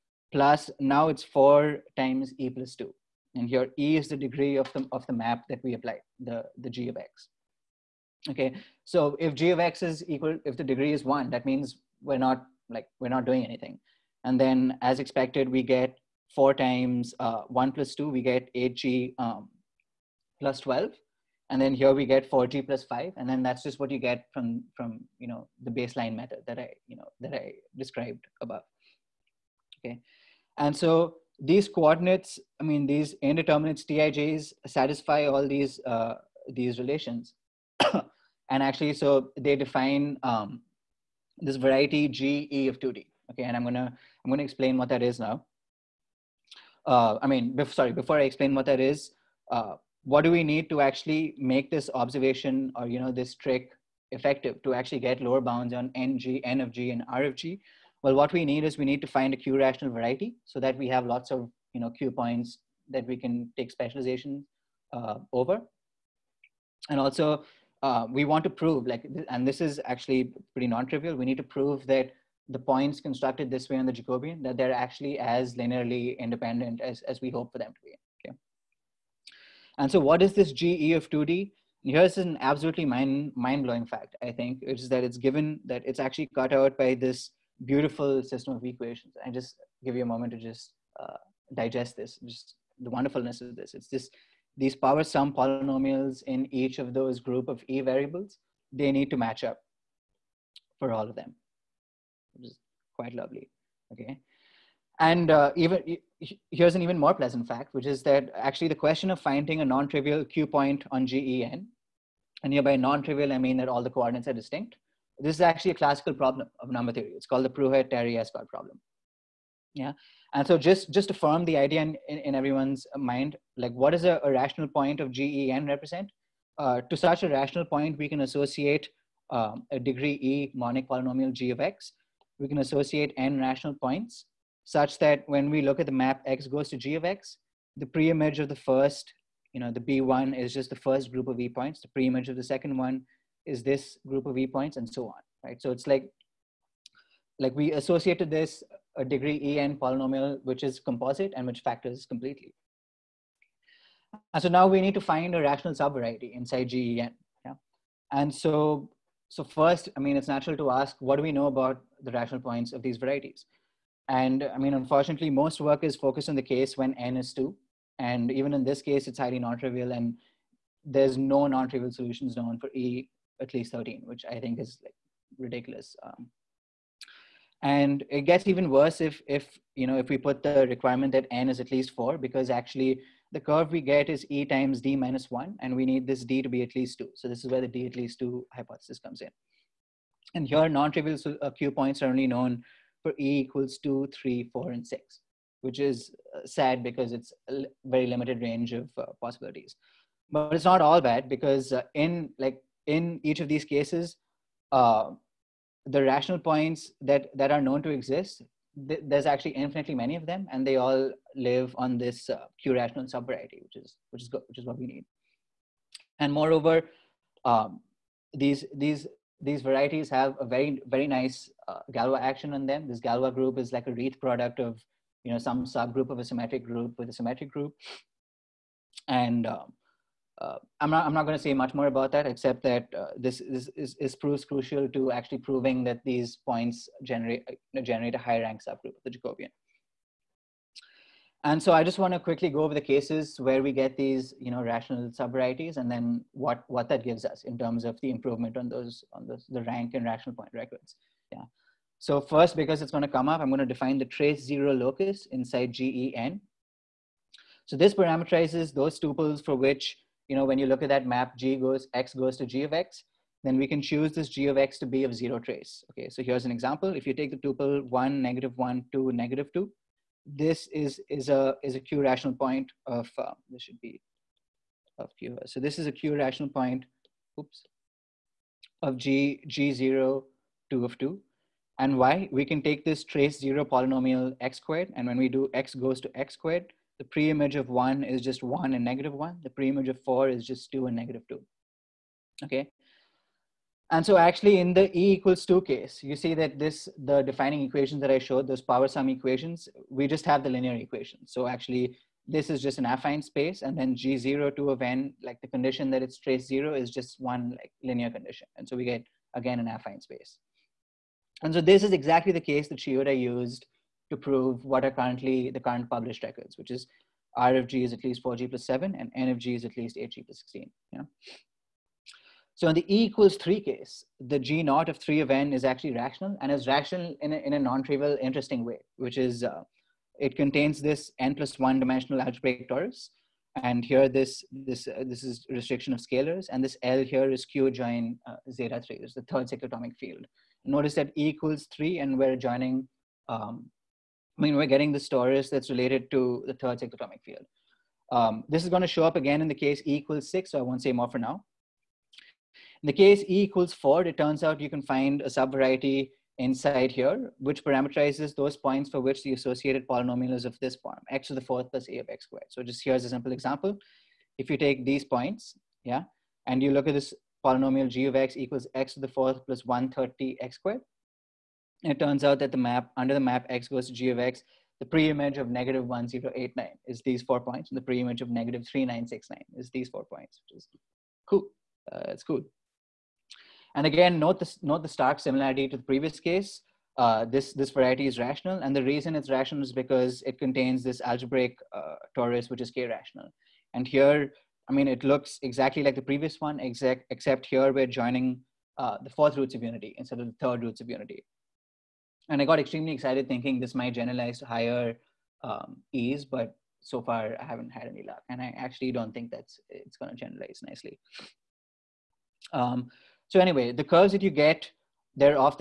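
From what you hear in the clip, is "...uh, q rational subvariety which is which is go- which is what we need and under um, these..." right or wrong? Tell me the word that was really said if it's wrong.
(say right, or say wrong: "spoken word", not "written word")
wrong: "moreover", not "under".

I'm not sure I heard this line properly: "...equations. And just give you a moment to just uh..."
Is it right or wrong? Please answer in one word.
right.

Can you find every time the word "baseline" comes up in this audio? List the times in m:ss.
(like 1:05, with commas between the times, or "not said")
0:25.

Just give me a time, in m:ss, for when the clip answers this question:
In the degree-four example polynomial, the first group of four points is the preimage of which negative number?
6:15.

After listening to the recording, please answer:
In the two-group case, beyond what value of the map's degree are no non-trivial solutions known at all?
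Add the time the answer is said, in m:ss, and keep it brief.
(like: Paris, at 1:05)
13, at 2:53.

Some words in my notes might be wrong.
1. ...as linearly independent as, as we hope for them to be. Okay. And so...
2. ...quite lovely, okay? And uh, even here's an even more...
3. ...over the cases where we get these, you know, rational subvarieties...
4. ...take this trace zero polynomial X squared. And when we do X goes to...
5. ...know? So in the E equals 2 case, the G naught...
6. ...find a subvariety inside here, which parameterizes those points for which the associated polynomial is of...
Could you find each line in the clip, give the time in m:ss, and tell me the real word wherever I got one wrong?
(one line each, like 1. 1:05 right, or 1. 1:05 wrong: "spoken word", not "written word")
1. 1:15 right
2. 1:42 right
3. 4:02 right
4. 4:42 right
5. 5:20 wrong: "3", not "2"
6. 5:54 right.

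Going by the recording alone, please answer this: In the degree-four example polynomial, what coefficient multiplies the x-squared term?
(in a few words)
130.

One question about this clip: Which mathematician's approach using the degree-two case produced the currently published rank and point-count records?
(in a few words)
Shioda.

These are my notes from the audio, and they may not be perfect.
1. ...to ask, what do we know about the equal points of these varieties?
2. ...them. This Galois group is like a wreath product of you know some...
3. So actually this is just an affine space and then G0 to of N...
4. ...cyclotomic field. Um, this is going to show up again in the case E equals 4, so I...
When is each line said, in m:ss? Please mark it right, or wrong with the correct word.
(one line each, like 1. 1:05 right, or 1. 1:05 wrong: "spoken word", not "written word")
1. 2:40 wrong: "rational", not "equal"
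2. 3:42 right
3. 5:01 right
4. 5:46 wrong: "6", not "4".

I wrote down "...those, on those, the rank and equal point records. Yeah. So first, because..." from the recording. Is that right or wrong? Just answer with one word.
wrong.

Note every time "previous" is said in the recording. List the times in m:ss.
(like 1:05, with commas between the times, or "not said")
6:25, 6:36.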